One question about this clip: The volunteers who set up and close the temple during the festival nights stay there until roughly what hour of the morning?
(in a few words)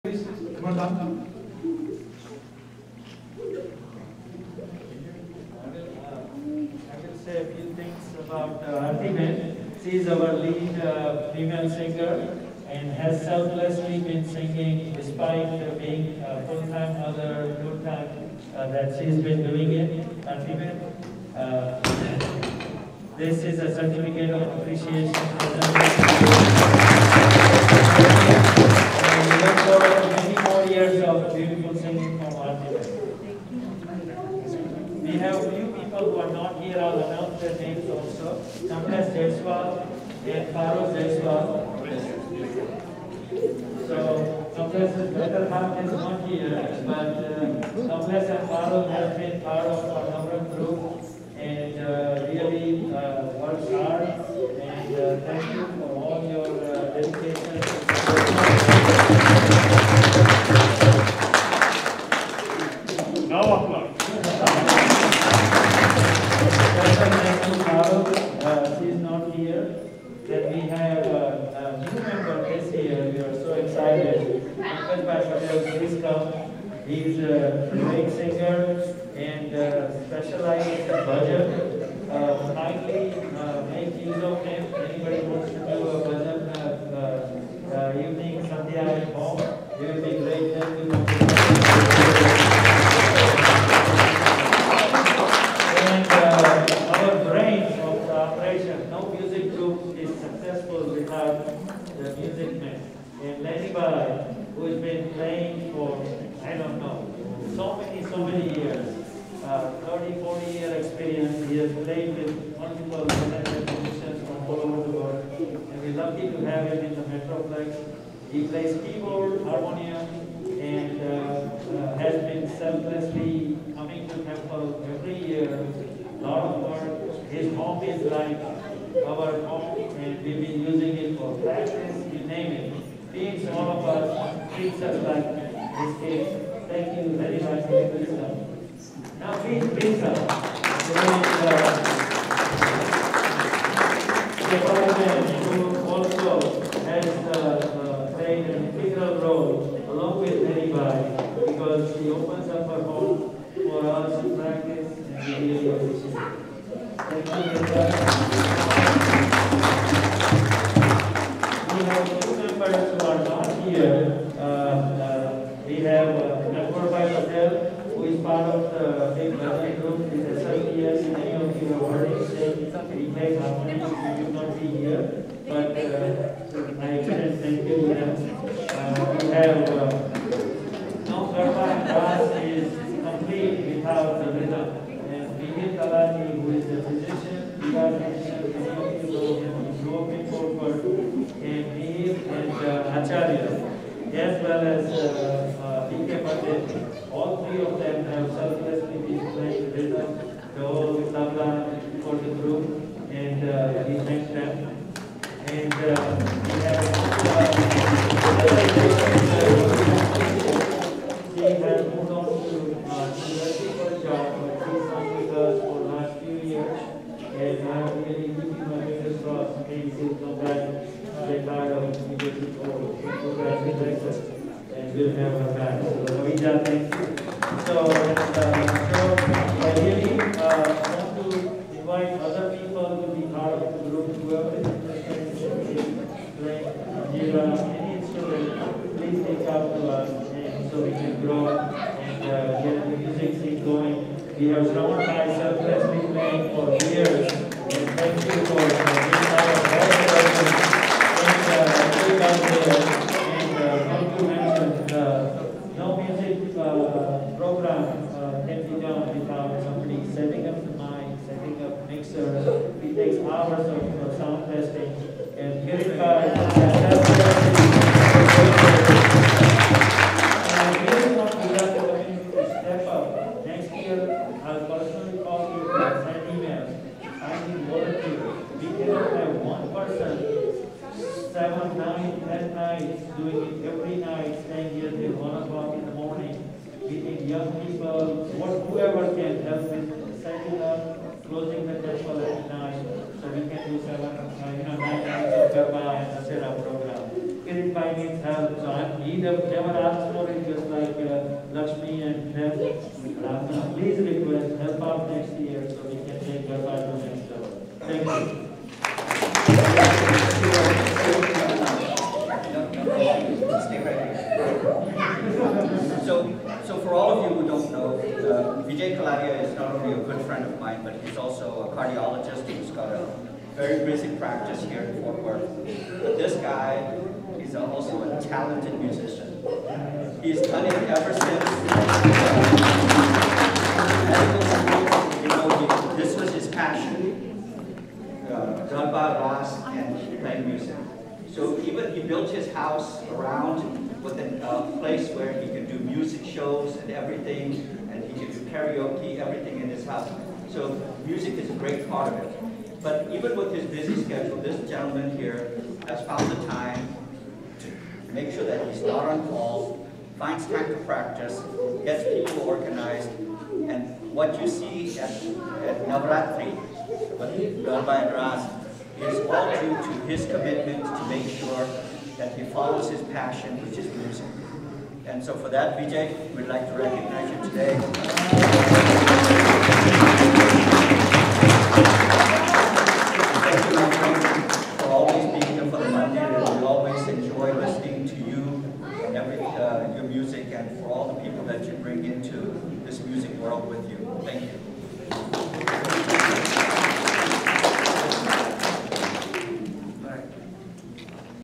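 1 o'clock.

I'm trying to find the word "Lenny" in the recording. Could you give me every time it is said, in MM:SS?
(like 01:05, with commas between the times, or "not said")
01:43.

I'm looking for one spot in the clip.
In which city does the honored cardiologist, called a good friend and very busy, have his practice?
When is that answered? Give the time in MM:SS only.
05:25.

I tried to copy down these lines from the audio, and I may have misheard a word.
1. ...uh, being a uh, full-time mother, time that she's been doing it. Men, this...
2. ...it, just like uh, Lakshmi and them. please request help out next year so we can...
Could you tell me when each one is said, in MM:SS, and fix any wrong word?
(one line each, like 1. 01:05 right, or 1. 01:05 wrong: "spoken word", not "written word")
1. 00:15 right
2. 05:00 right.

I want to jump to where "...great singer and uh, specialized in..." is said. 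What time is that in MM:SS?
01:17.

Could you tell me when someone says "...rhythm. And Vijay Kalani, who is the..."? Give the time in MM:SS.
03:04.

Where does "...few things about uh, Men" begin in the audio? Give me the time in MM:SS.
00:07.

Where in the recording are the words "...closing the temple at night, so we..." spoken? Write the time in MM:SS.
04:51.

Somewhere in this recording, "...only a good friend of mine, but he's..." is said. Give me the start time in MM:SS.
05:19.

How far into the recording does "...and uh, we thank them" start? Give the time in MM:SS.
03:23.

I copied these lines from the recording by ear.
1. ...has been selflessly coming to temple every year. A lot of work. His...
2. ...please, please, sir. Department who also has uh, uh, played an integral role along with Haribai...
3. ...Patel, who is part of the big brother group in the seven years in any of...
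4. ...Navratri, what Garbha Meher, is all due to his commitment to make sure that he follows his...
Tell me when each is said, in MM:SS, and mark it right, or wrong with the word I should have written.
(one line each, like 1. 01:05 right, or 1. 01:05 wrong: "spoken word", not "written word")
1. 02:01 right
2. 02:19 right
3. 02:47 right
4. 06:05 wrong: "Ras", not "Meher".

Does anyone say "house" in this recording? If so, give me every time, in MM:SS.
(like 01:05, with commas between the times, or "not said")
05:42, 05:49.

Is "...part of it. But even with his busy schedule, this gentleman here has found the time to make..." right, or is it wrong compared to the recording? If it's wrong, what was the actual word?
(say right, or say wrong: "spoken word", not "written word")
right.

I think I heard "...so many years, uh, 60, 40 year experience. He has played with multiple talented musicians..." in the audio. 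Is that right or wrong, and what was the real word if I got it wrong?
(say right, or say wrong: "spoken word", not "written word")
wrong: "30", not "60".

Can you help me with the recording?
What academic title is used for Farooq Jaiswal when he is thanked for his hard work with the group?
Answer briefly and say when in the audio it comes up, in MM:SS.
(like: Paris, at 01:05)
Professor, at 00:47.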